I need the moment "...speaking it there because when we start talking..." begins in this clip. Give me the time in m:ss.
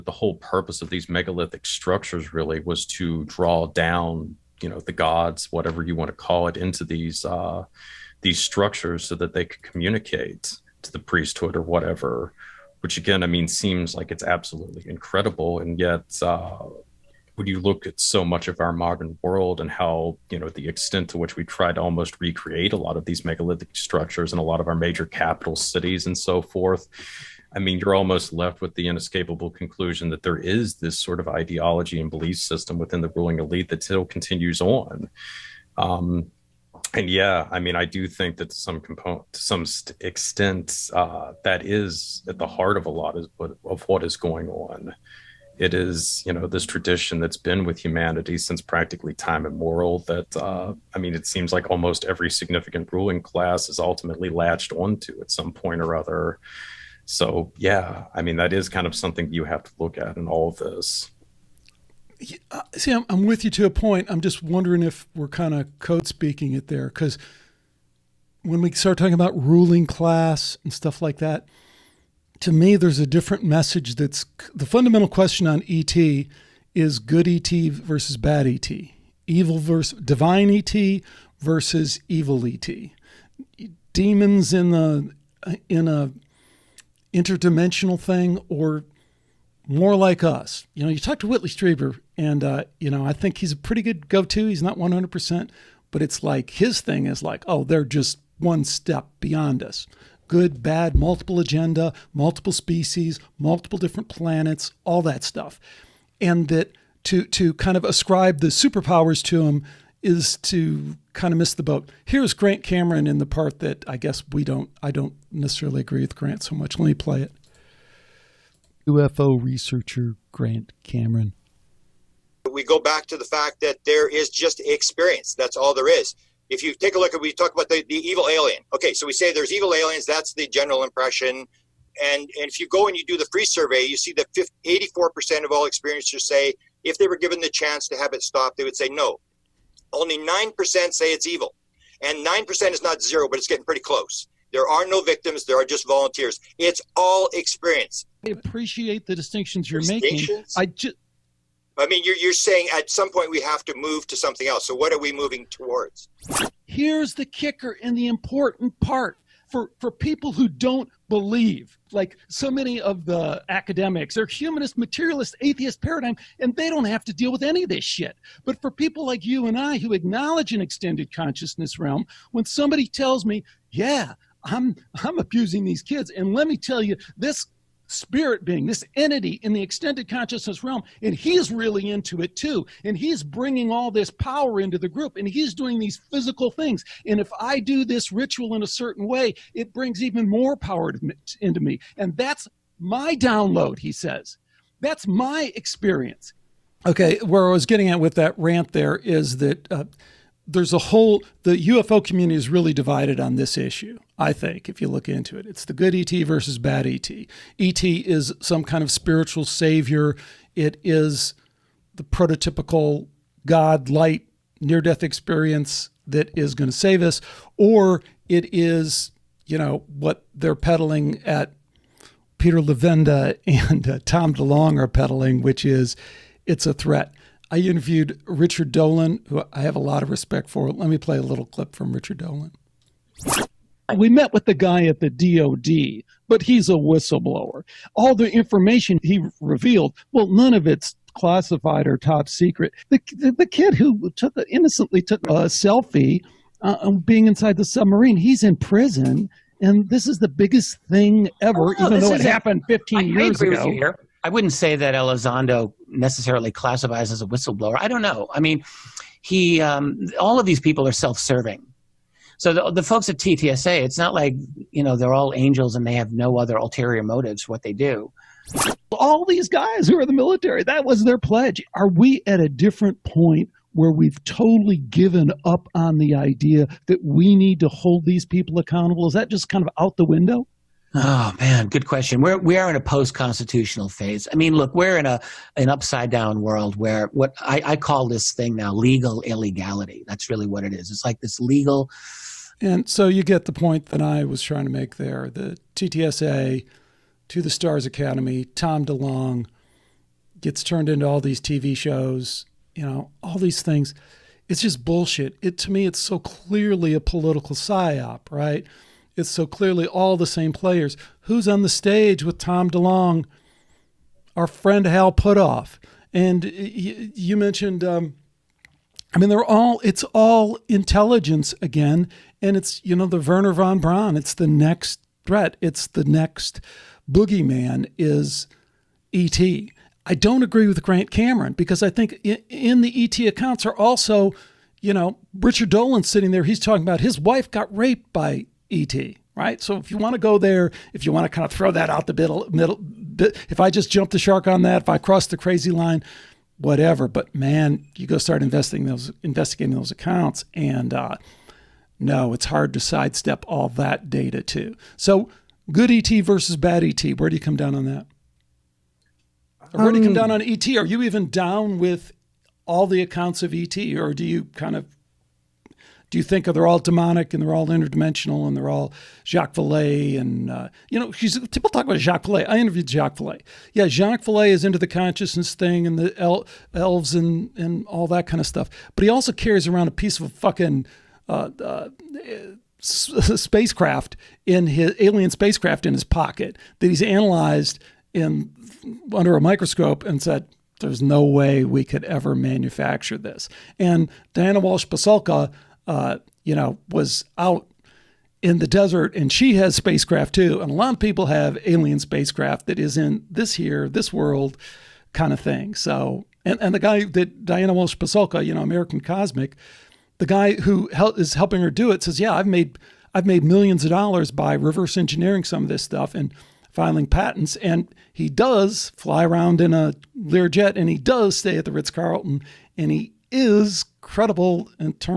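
1:06.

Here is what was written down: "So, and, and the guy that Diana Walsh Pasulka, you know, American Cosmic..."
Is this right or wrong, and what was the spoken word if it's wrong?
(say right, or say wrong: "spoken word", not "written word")
right.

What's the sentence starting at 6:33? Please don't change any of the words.
And Diana Walsh Pasulka uh, you know, was out in the desert and she has spacecraft too.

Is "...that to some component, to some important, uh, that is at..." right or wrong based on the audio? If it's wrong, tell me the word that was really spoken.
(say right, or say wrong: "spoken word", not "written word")
wrong: "extent", not "important".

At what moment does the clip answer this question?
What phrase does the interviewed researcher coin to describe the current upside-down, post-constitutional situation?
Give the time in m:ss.
4:48.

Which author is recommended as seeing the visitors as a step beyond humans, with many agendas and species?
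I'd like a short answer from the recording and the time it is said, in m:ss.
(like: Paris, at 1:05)
Whitley Strieber, at 1:31.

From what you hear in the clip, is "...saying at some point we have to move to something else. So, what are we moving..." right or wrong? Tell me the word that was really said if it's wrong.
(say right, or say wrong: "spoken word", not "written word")
right.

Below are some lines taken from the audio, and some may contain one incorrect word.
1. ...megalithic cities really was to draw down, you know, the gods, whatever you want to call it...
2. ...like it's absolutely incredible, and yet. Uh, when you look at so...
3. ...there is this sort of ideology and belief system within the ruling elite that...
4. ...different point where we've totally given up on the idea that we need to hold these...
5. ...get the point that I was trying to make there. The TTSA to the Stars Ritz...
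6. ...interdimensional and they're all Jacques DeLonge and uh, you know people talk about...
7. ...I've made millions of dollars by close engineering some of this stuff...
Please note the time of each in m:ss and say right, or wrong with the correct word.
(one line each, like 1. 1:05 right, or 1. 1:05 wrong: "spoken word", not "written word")
1. 0:01 wrong: "structures", not "cities"
2. 0:13 right
3. 0:30 right
4. 4:32 right
5. 4:53 wrong: "Academy", not "Ritz"
6. 6:07 wrong: "Vallée", not "DeLonge"
7. 6:53 wrong: "reverse", not "close".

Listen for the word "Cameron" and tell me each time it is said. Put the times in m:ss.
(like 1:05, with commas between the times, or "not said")
1:52, 2:00, 5:31.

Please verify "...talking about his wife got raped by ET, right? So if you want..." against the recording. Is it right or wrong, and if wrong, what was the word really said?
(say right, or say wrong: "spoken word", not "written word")
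right.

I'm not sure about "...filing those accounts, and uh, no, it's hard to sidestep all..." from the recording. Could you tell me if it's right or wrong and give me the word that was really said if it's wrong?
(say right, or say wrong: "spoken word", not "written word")
wrong: "investigating", not "filing".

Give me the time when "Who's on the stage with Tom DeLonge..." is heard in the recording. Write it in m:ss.
5:11.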